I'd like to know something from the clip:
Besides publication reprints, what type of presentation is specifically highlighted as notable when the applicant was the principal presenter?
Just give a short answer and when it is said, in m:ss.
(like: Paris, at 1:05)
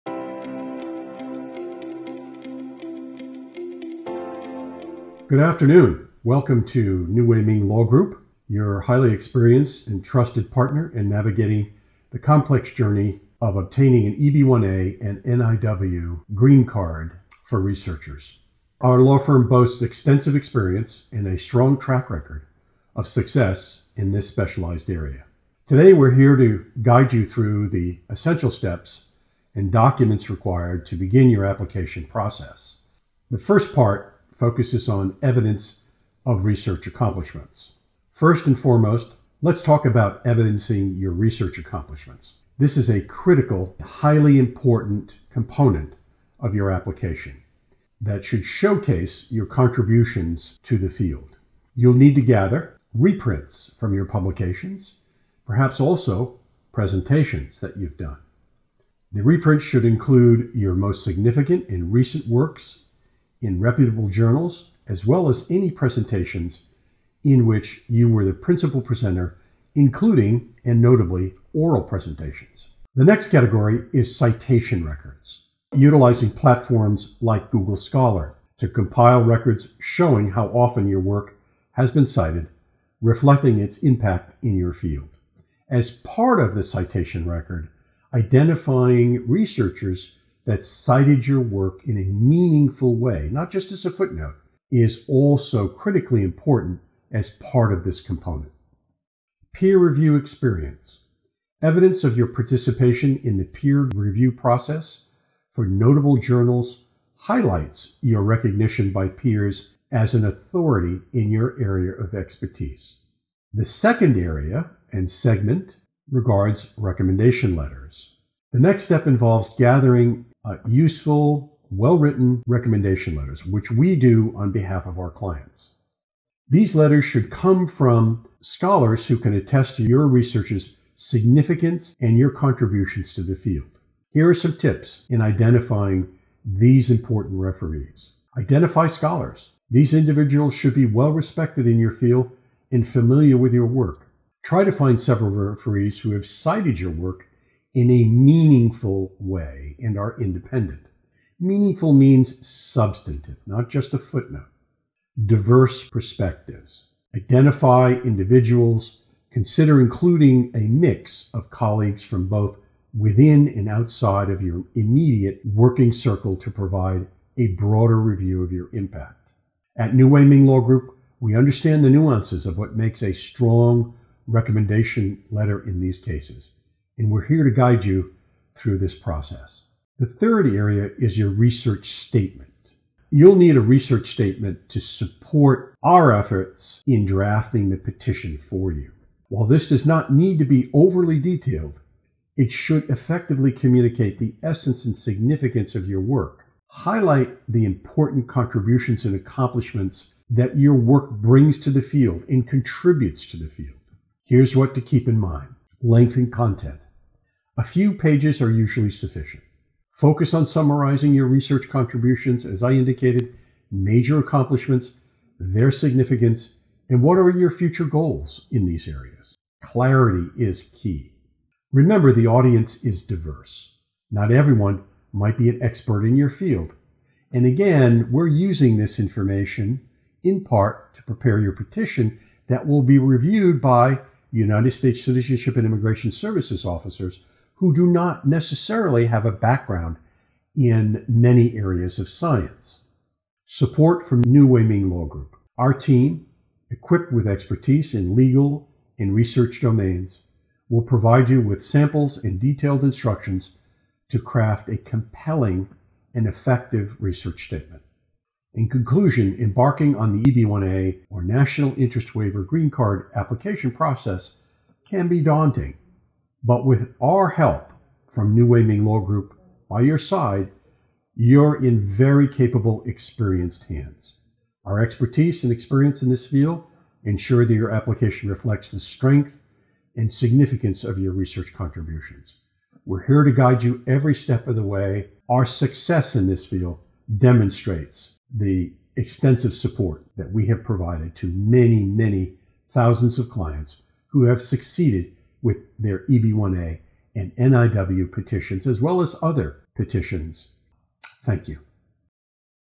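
Oral presentations, at 1:11.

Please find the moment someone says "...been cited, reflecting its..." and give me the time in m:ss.
1:21.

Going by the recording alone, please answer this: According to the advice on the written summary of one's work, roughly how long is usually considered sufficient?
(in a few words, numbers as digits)
A few pages.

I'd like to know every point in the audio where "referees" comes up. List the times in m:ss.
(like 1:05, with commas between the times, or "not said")
2:17, 2:25.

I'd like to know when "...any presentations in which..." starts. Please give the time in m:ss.
1:05.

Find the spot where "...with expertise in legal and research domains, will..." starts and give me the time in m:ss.
4:07.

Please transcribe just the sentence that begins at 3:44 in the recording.
Not everyone might be an expert in your field.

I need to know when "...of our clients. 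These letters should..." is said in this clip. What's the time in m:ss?
2:04.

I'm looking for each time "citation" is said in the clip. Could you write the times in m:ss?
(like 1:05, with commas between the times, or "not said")
1:14, 1:26.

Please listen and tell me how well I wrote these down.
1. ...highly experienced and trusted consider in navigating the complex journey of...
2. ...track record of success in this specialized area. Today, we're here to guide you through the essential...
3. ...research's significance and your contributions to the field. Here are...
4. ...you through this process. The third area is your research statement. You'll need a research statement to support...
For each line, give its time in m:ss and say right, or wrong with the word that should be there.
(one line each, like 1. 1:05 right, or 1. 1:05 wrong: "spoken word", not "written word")
1. 0:08 wrong: "partner", not "consider"
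2. 0:21 right
3. 2:10 right
4. 2:57 right.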